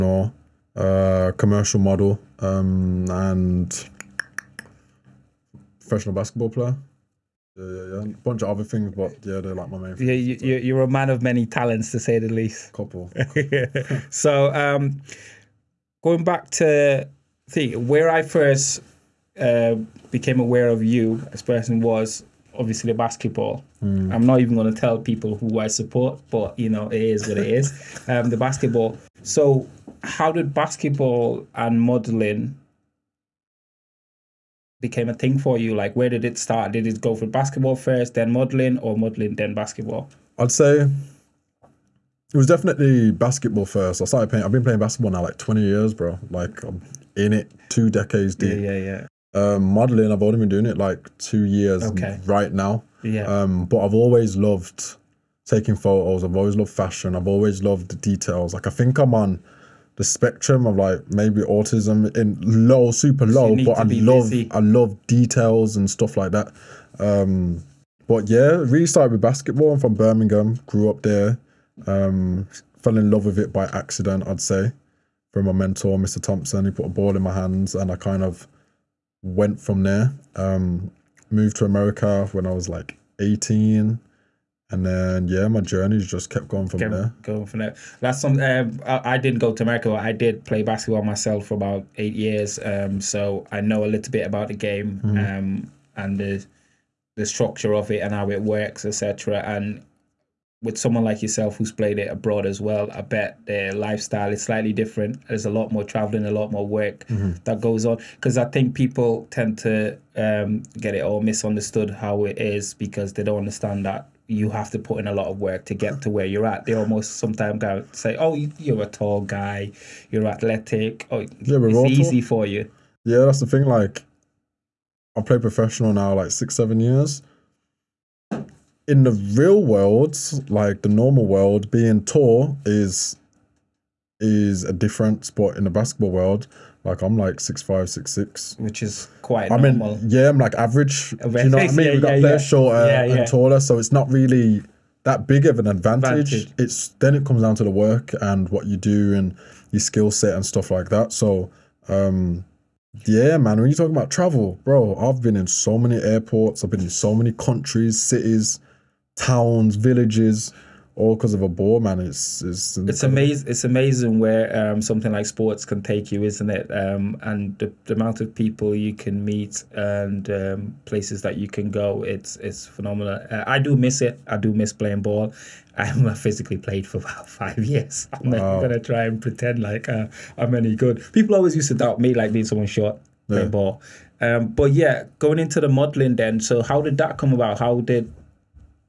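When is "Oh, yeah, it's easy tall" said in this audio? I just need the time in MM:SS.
02:01.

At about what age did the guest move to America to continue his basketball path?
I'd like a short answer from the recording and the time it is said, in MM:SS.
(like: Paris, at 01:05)
18, at 01:23.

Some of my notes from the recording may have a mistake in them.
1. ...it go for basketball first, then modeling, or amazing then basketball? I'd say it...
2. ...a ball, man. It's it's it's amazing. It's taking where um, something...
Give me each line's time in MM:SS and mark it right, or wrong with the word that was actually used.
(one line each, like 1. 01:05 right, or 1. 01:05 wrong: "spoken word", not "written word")
1. 00:36 wrong: "modeling", not "amazing"
2. 02:41 wrong: "amazing", not "taking".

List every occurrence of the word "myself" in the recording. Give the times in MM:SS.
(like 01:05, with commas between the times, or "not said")
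01:31.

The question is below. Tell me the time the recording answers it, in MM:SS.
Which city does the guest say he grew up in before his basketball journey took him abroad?
01:09.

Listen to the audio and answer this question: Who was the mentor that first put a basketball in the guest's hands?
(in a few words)
Mr. Thompson.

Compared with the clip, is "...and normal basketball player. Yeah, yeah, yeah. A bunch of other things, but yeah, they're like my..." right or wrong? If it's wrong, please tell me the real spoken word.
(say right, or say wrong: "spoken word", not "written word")
wrong: "professional", not "normal".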